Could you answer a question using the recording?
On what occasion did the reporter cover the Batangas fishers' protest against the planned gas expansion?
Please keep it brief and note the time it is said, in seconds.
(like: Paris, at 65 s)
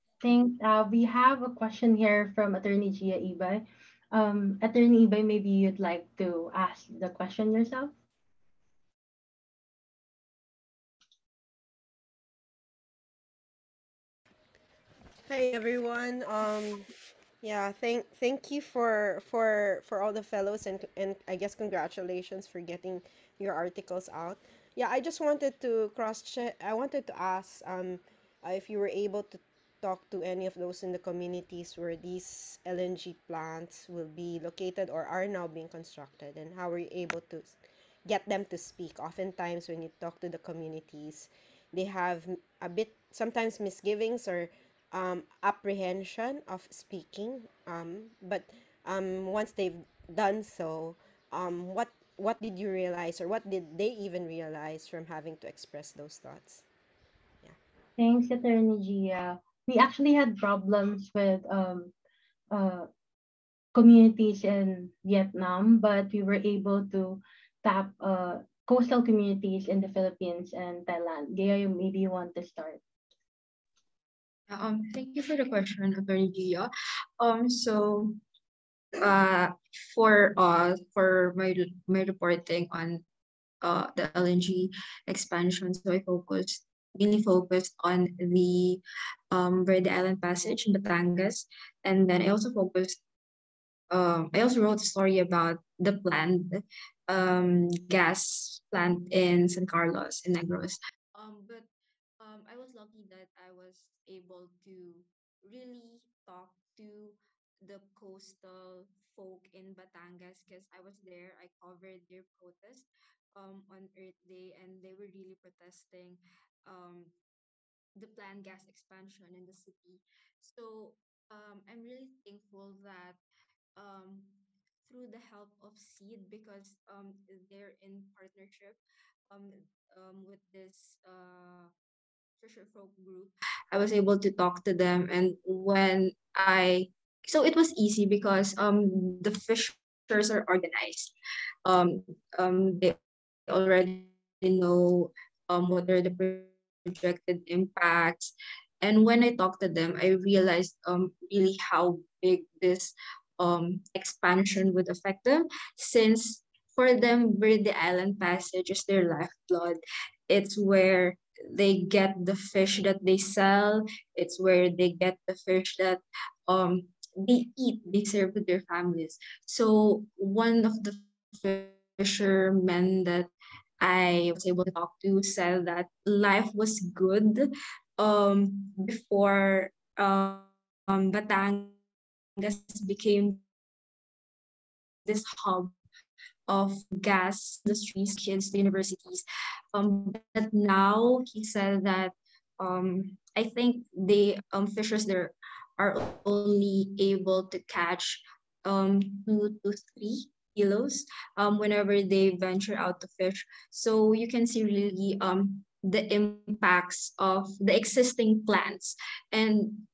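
Earth Day, at 113 s.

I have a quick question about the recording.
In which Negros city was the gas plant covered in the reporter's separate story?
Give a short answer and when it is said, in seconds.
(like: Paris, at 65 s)
San Carlos, at 99 s.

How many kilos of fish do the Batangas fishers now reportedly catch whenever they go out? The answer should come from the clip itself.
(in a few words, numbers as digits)
2 to 3 kilos.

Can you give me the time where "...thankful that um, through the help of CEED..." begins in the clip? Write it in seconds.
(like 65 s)
122 s.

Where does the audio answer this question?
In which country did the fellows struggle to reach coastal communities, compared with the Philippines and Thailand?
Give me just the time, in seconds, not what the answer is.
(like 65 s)
65 s.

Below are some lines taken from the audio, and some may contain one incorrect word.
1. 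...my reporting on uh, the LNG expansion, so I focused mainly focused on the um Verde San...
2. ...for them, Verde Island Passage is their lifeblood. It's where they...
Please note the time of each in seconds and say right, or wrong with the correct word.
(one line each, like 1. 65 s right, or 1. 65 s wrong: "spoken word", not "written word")
1. 81 s wrong: "Island", not "San"
2. 156 s right.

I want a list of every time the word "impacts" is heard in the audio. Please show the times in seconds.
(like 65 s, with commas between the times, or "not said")
147 s, 206 s.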